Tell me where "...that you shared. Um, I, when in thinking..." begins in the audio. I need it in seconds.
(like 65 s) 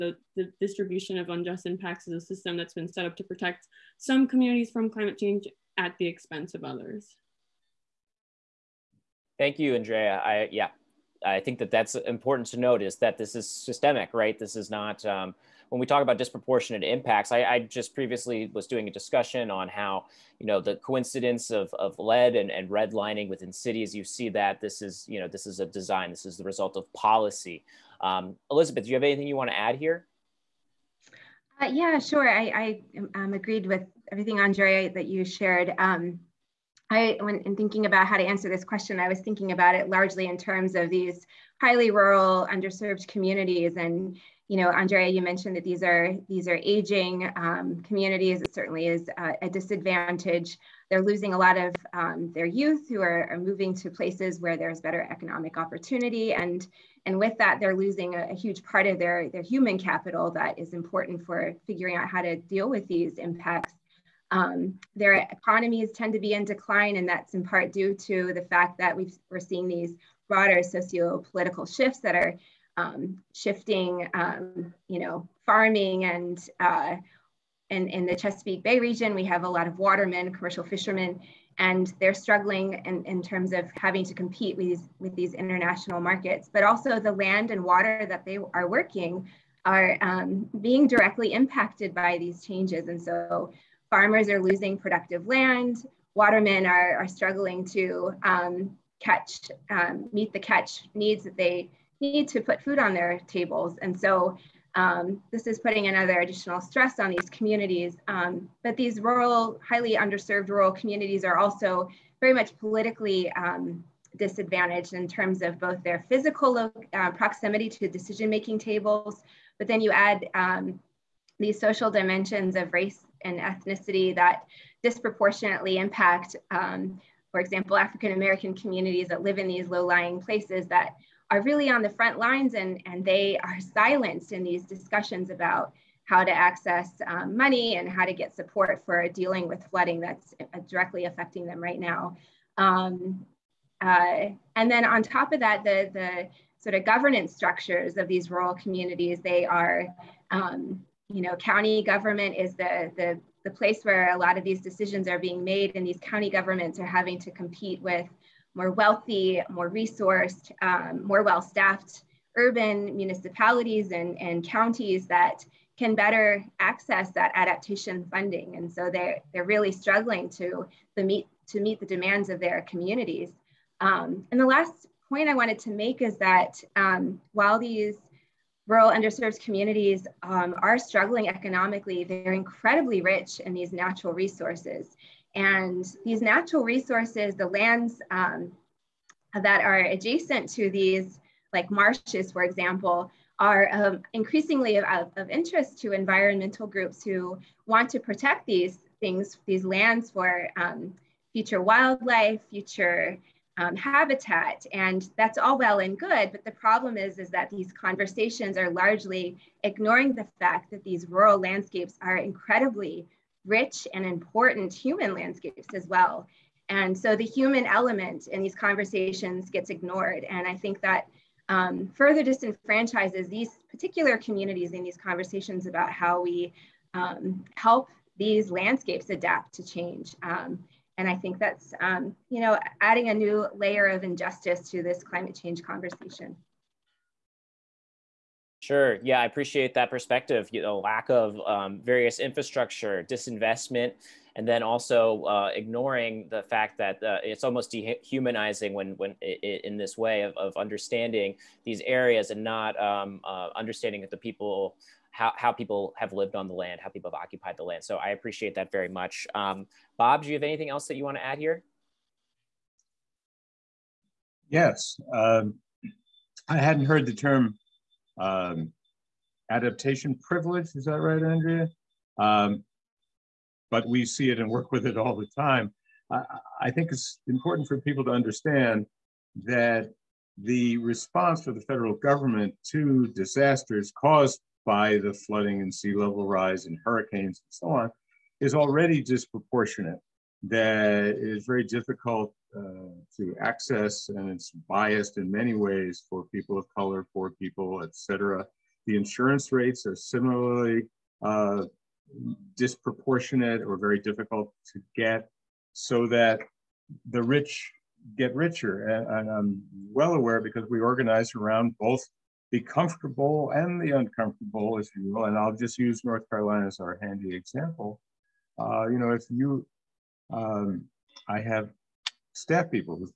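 34 s.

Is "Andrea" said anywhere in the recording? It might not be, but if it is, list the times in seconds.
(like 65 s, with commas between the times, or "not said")
9 s, 34 s, 44 s, 271 s.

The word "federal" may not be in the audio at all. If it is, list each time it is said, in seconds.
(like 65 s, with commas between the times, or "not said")
281 s.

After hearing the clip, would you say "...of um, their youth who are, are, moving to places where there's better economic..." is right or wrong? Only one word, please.
right.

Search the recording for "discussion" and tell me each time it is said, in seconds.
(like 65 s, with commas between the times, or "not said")
18 s, 134 s.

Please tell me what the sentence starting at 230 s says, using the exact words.
Um, and I think that's, um, you know, adding a new layer of injustice to this climate change conversation.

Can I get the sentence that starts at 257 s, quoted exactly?
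So I appreciate that very much.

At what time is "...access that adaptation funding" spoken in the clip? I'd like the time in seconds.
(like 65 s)
166 s.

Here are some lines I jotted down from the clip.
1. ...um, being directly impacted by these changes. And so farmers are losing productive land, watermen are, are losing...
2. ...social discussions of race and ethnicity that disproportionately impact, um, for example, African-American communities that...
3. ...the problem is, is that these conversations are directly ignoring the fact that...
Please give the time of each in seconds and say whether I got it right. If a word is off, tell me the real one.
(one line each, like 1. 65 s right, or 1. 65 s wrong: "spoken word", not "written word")
1. 89 s wrong: "struggling", not "losing"
2. 121 s wrong: "dimensions", not "discussions"
3. 206 s wrong: "largely", not "directly".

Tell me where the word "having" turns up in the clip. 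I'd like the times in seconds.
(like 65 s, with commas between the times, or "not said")
83 s, 156 s.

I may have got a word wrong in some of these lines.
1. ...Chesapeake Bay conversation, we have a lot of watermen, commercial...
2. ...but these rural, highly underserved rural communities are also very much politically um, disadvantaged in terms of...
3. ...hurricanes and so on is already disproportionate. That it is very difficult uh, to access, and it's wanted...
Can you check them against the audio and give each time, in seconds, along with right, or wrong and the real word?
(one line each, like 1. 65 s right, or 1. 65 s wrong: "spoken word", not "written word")
1. 78 s wrong: "region", not "conversation"
2. 108 s right
3. 286 s wrong: "biased", not "wanted".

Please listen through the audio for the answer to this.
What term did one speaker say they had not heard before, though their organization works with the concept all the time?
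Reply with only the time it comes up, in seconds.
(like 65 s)
269 s.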